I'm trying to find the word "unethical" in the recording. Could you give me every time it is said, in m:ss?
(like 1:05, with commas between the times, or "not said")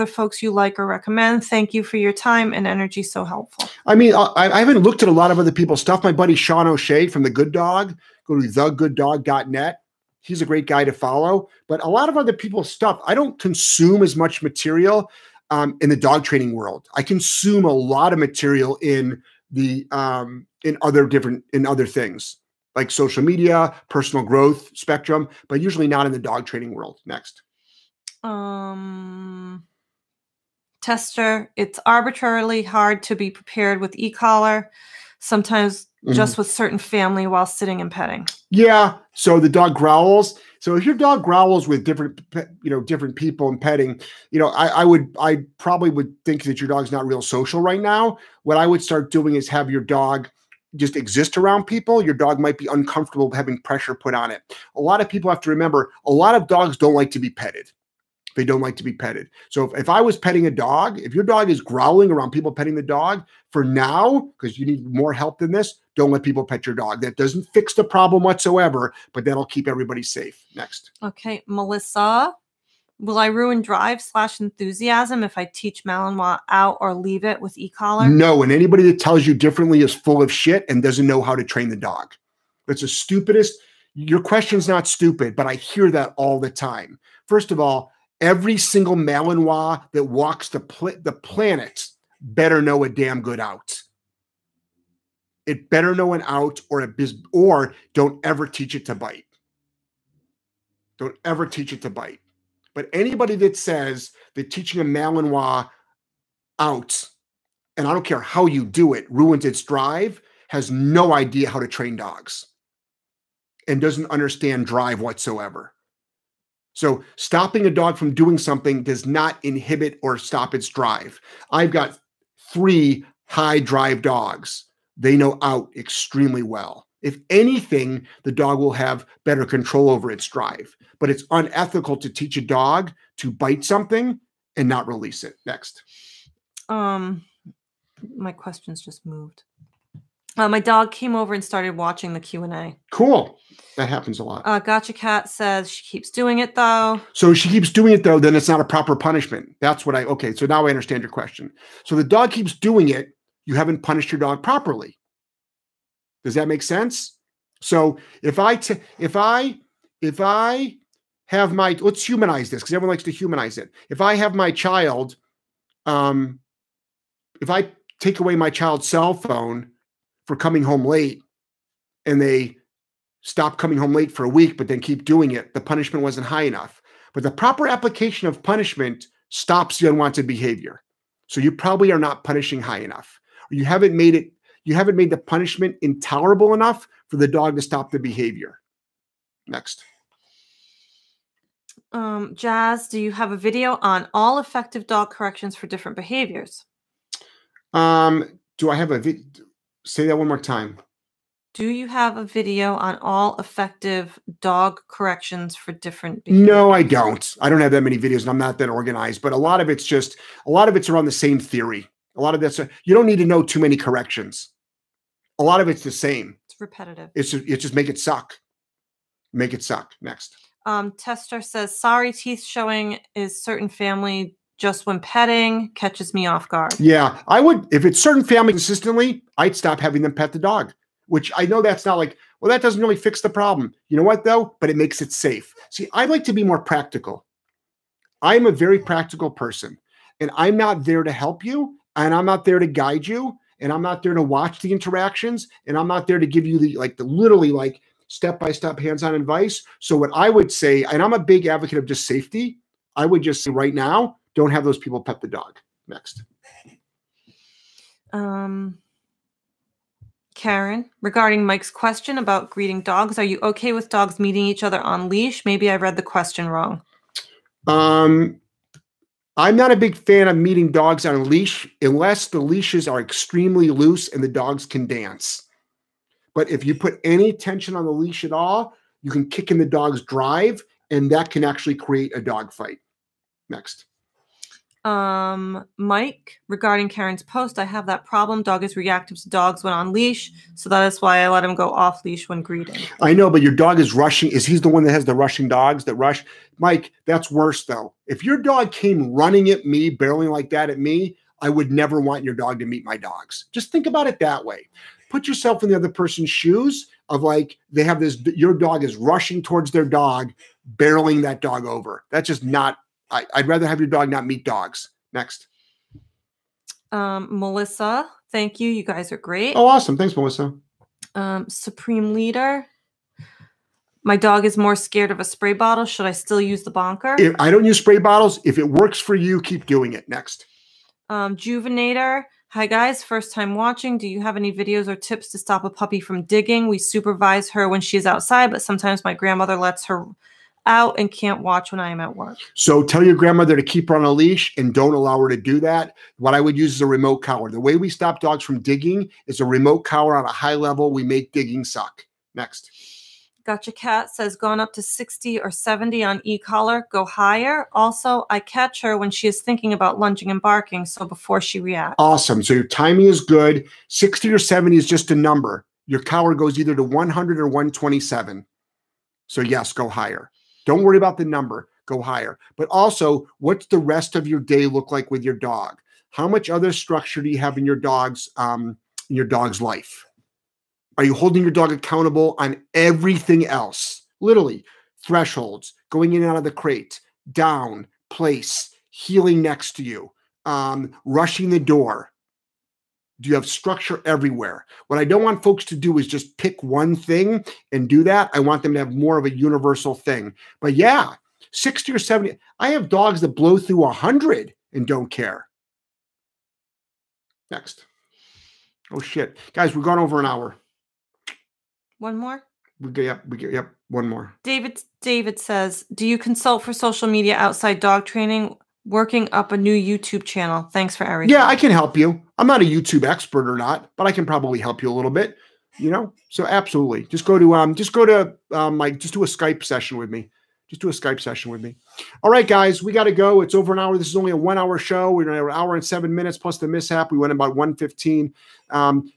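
2:11.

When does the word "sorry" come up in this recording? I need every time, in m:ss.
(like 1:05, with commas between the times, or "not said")
3:41.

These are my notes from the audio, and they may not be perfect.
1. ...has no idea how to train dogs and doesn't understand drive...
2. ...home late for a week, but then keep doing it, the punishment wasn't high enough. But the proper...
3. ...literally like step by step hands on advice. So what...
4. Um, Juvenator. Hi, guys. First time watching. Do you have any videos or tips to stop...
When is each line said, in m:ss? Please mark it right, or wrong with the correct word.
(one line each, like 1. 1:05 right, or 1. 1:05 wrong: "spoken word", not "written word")
1. 1:50 right
2. 2:53 right
3. 4:07 right
4. 5:31 right.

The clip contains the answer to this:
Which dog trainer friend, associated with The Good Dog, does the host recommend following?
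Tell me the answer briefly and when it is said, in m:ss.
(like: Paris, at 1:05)
Sean O'Shea, at 0:06.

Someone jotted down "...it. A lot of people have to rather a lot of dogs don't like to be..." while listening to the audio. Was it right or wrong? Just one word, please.
wrong.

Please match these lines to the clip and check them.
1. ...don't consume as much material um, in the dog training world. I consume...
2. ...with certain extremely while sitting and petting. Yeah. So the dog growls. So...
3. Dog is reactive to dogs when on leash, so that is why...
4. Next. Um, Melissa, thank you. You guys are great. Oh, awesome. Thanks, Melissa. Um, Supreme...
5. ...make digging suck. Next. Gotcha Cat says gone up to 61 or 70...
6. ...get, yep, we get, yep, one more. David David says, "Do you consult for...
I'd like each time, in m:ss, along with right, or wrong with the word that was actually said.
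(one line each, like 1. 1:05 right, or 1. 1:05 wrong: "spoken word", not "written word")
1. 0:13 right
2. 0:36 wrong: "family", not "extremely"
3. 4:48 right
4. 5:15 right
5. 5:51 wrong: "60", not "61"
6. 6:52 right.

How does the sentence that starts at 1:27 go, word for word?
First of all, every single Malinois that walks the pl the planet better know a damn good out.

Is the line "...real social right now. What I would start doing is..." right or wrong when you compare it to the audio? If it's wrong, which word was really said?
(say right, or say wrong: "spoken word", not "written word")
right.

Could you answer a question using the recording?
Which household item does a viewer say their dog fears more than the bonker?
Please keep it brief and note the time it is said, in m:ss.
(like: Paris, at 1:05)
Spray bottle, at 5:25.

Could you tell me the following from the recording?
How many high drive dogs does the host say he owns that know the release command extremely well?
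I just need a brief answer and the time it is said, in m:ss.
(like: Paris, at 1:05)
3, at 2:02.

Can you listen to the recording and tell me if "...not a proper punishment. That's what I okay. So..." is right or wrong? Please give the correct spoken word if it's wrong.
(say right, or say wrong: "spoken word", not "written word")
right.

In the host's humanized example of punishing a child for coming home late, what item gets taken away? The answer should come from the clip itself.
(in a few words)
Cell phone.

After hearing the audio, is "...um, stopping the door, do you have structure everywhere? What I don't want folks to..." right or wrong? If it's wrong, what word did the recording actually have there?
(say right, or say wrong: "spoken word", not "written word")
wrong: "rushing", not "stopping".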